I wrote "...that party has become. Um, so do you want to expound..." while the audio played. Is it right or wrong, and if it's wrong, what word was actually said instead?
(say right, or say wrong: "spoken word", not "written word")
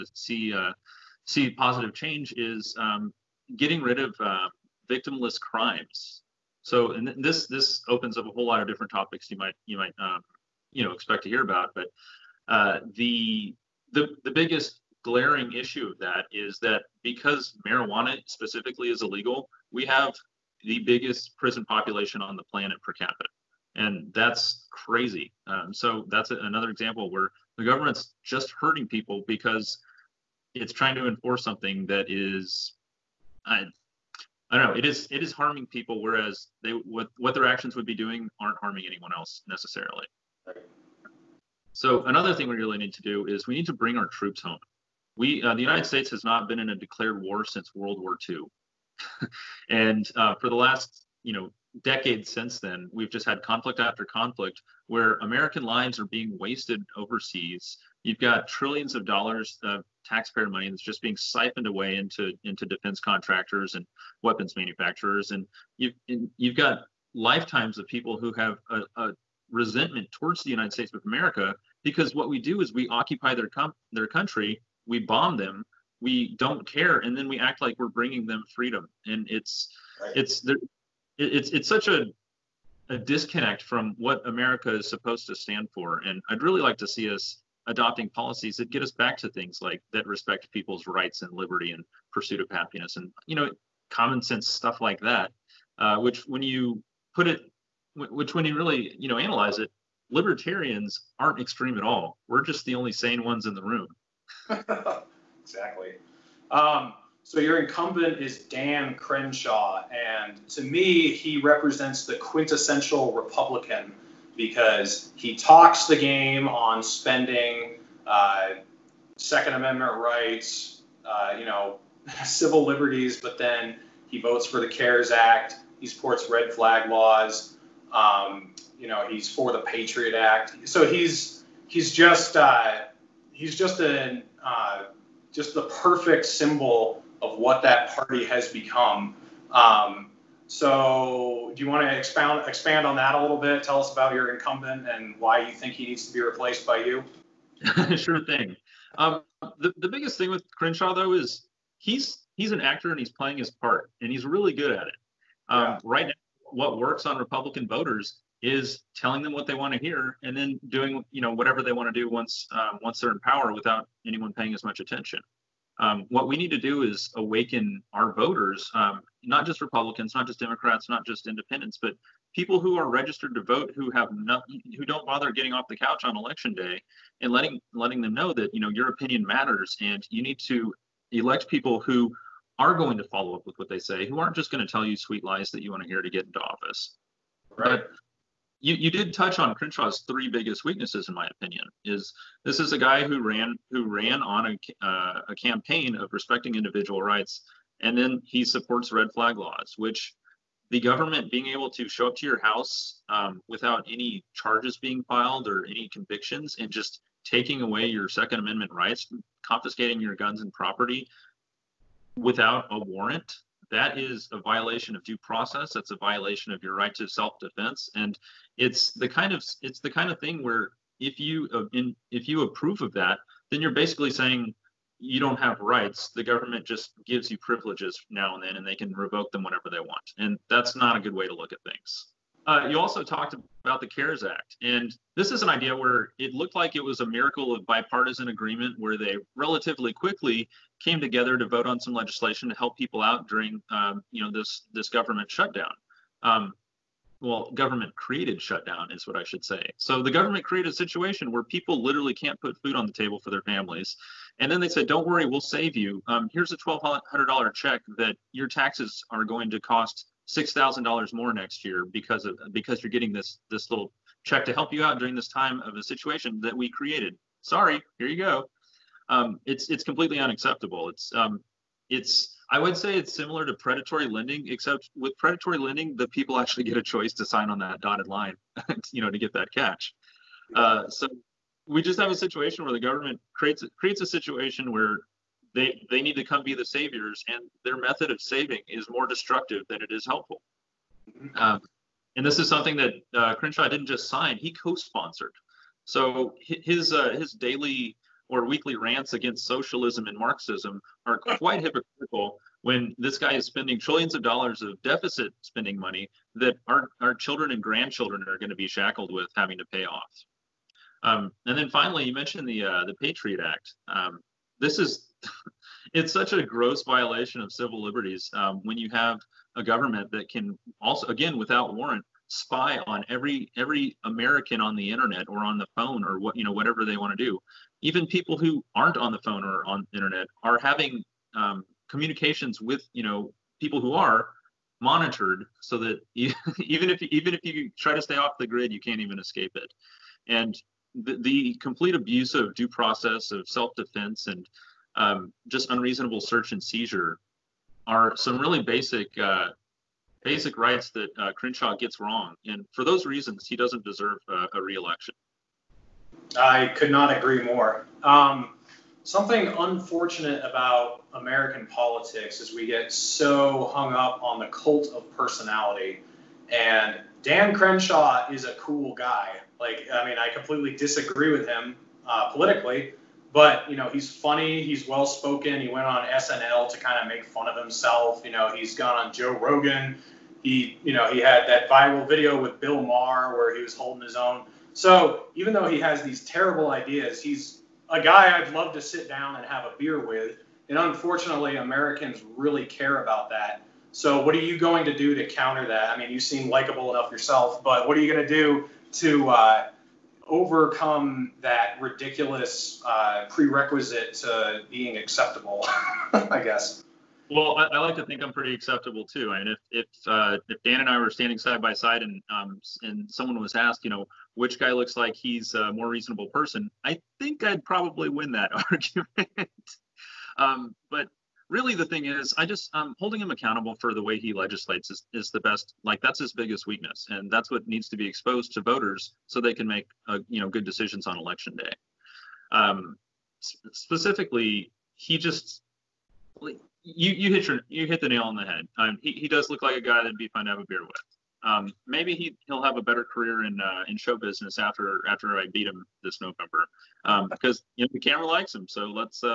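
right.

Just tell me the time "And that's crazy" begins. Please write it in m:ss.
0:23.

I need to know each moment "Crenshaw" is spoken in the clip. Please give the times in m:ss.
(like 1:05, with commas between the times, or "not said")
1:48, 2:30, 3:09, 4:53, 5:51, 6:07.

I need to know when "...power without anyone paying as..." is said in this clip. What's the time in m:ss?
2:43.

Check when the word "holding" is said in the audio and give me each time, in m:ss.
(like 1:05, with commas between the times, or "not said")
6:23, 7:02.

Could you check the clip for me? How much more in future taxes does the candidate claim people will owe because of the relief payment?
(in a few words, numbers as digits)
$6,000.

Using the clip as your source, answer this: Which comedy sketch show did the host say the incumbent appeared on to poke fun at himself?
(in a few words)
SNL.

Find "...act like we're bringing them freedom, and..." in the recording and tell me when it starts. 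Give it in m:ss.
1:17.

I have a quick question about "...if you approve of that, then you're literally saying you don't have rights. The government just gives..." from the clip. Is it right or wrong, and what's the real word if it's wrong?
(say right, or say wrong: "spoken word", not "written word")
wrong: "basically", not "literally".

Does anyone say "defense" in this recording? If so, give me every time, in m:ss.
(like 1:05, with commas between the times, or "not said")
1:02, 3:37, 5:43.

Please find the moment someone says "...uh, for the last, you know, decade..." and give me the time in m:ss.
0:50.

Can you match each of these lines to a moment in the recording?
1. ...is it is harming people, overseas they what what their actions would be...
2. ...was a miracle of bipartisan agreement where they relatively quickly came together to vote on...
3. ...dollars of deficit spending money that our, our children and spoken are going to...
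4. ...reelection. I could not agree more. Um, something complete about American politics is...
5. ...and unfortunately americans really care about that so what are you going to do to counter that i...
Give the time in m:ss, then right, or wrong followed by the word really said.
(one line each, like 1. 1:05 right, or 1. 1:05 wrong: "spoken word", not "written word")
1. 0:34 wrong: "whereas", not "overseas"
2. 3:56 right
3. 5:04 wrong: "grandchildren", not "spoken"
4. 5:54 wrong: "unfortunate", not "complete"
5. 6:30 right.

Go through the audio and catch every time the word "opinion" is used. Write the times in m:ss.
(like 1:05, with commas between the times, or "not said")
2:58, 3:11.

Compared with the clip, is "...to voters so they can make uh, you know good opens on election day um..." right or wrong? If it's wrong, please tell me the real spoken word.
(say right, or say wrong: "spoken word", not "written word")
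wrong: "decisions", not "opens".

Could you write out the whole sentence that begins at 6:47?
Well, I, I, like to think I'm pretty acceptable too.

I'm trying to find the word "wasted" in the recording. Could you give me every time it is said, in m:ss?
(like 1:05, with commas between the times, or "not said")
0:56.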